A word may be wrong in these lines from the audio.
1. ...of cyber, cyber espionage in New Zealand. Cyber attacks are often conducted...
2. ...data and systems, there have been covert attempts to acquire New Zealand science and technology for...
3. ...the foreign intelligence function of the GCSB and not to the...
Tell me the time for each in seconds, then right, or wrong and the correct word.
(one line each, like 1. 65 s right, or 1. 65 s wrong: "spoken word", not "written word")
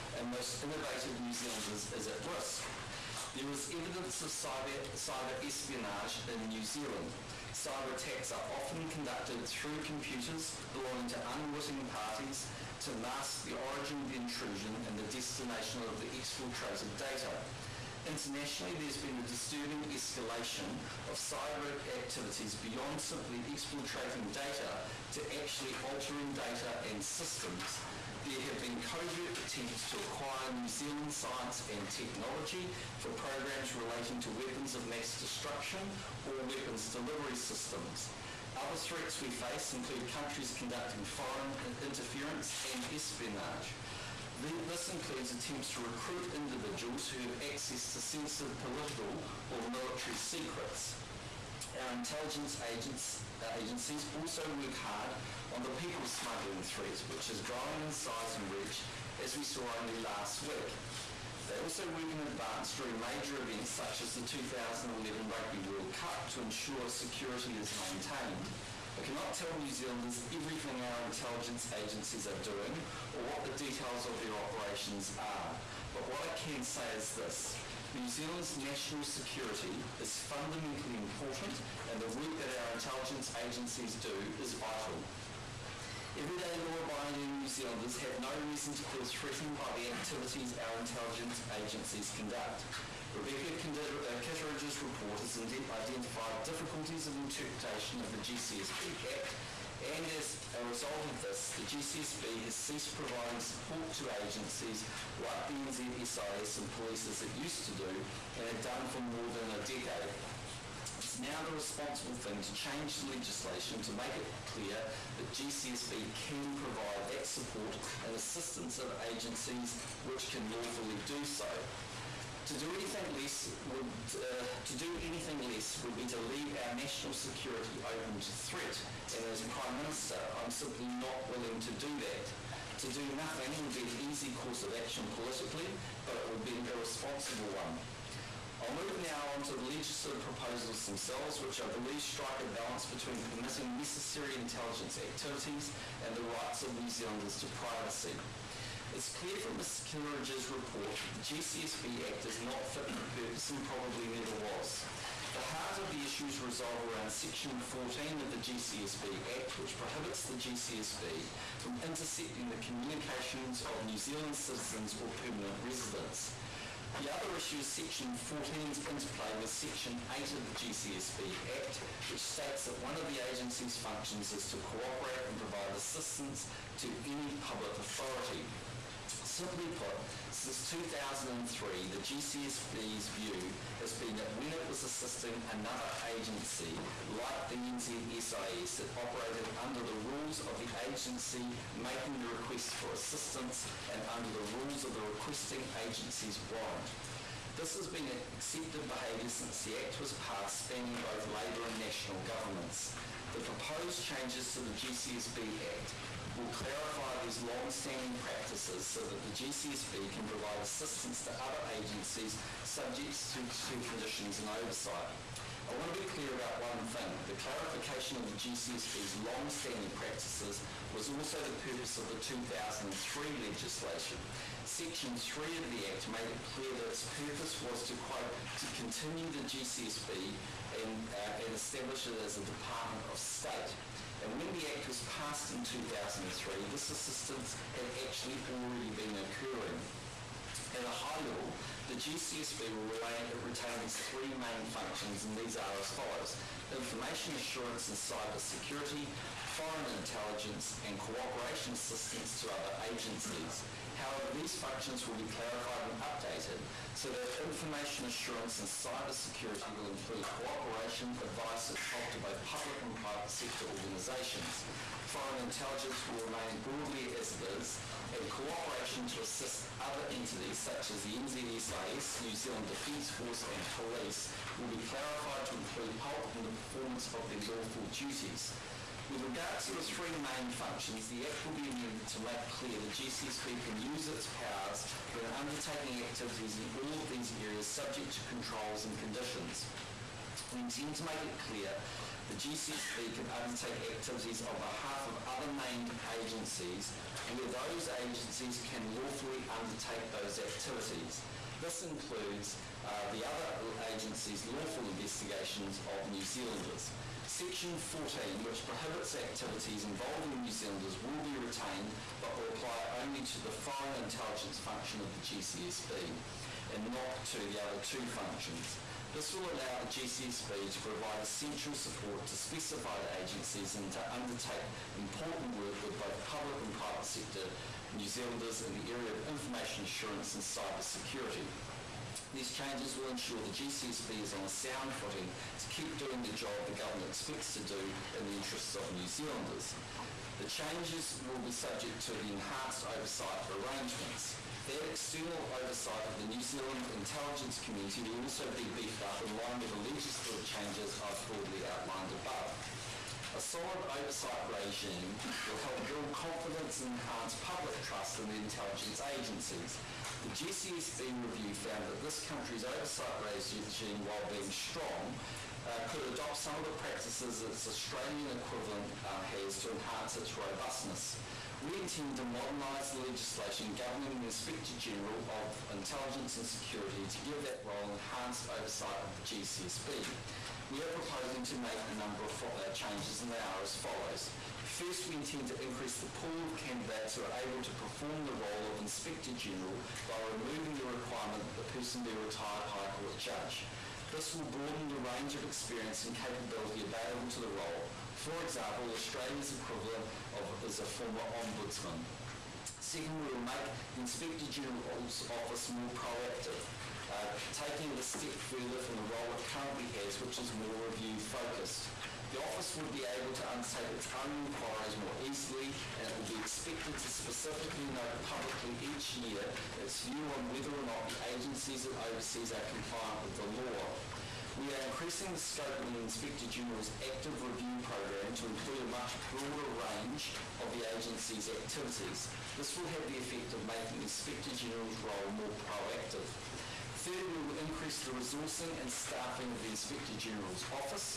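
1. 4 s right
2. 26 s right
3. 313 s right.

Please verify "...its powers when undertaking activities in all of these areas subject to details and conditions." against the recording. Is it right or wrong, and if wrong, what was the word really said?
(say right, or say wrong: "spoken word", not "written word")
wrong: "controls", not "details".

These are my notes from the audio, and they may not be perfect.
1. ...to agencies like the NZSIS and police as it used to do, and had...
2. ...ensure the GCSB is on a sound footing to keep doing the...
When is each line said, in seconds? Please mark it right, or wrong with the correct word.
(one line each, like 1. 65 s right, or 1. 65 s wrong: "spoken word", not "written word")
1. 103 s right
2. 333 s right.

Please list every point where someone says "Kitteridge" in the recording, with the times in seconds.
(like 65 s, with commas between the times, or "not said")
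94 s, 149 s.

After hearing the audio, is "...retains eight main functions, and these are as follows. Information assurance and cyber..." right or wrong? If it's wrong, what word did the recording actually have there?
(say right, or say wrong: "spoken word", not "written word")
wrong: "three", not "eight".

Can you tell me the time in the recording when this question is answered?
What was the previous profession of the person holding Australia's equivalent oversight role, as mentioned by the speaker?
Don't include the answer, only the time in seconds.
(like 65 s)
401 s.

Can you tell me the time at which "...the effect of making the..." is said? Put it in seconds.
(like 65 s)
433 s.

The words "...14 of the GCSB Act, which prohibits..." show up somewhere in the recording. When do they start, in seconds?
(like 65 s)
157 s.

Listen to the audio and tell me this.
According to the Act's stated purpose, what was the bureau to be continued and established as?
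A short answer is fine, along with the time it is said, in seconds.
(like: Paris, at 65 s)
Department of State, at 232 s.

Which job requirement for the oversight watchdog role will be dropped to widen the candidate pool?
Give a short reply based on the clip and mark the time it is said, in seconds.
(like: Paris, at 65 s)
retired High Court judge, at 392 s.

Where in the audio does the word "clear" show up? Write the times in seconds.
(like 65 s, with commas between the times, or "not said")
114 s, 149 s, 216 s, 226 s, 282 s, 291 s.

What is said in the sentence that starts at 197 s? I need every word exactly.
This has been accepted behaviour since the Act was passed, spanning both Labour and national governments.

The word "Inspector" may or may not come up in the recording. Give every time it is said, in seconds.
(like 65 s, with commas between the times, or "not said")
374 s, 388 s, 404 s, 425 s, 434 s, 439 s.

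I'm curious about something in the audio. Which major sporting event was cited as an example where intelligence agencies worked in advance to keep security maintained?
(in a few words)
2011 Rugby World Cup.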